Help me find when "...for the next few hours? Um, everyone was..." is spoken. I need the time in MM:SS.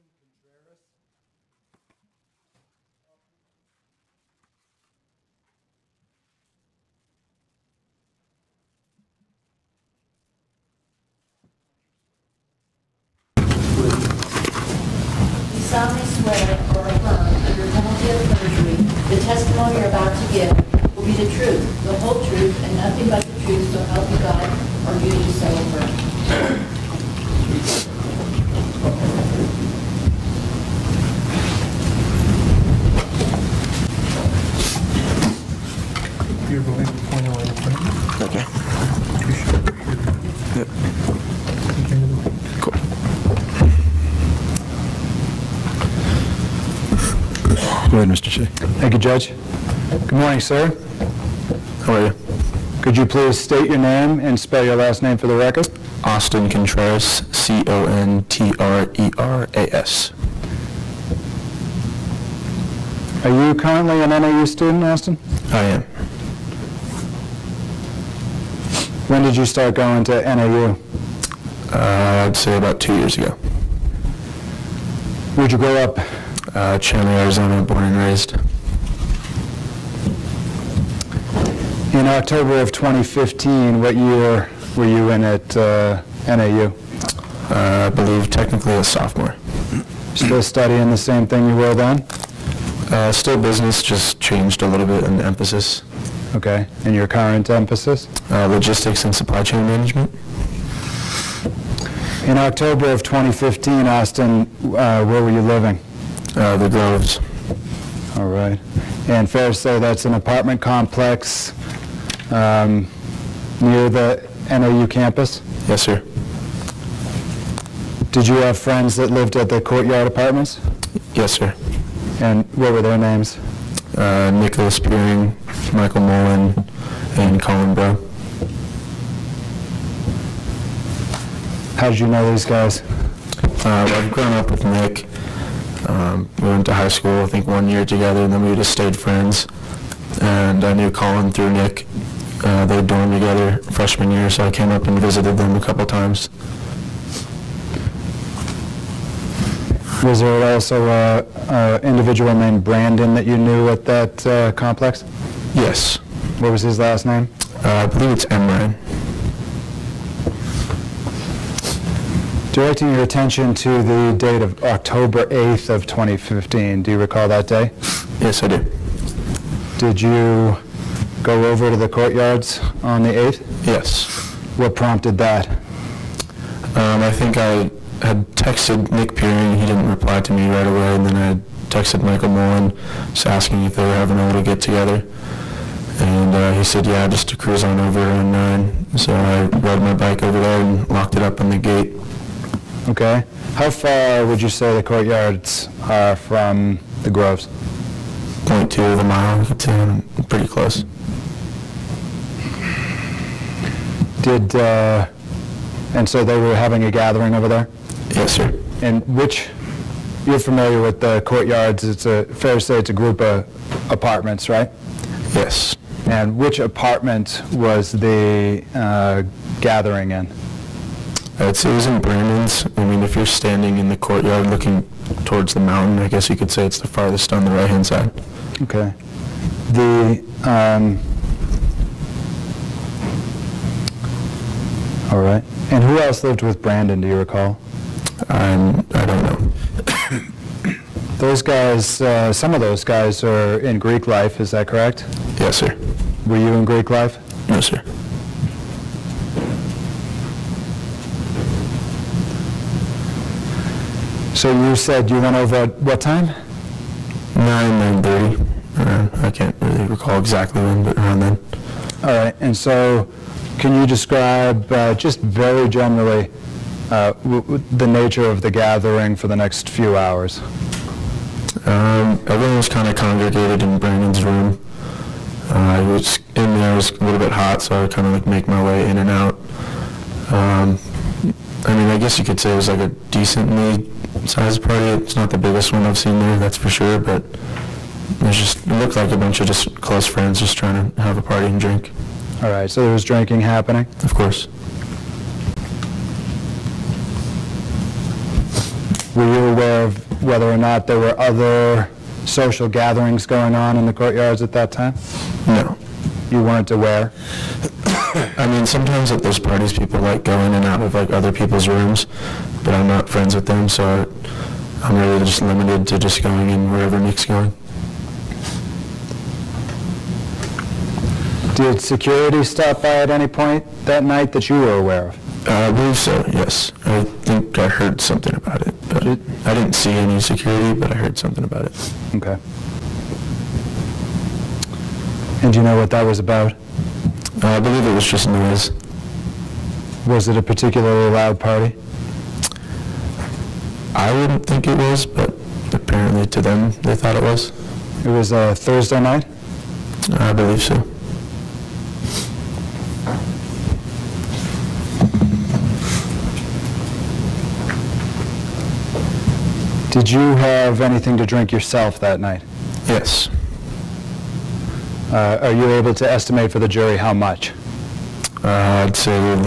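04:29.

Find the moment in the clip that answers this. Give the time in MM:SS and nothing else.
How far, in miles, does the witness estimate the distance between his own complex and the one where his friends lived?
03:18.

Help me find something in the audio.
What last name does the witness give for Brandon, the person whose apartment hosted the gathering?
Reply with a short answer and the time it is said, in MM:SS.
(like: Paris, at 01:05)
Emran, at 02:38.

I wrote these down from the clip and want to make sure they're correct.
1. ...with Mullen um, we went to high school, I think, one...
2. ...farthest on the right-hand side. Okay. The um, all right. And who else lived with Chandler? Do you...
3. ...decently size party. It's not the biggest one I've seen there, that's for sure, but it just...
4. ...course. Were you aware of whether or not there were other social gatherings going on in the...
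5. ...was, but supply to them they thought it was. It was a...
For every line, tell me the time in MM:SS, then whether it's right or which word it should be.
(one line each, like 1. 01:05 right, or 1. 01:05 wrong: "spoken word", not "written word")
1. 02:14 wrong: "Nick", not "Mullen"
2. 03:46 wrong: "Brandon", not "Chandler"
3. 04:42 right
4. 04:54 right
5. 05:44 wrong: "apparently", not "supply".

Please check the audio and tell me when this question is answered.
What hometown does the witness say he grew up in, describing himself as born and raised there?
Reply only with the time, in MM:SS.
01:16.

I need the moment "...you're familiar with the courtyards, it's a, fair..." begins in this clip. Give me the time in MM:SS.
03:30.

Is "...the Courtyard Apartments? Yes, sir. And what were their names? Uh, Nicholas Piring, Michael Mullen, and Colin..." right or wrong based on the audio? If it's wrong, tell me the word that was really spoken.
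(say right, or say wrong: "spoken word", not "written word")
right.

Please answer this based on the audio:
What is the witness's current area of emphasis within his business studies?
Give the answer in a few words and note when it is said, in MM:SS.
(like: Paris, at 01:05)
Logistics and supply chain management, at 01:38.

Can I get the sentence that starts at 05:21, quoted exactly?
Did security stop by at any point that night that you were aware of?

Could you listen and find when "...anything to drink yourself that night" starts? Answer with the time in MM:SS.
06:00.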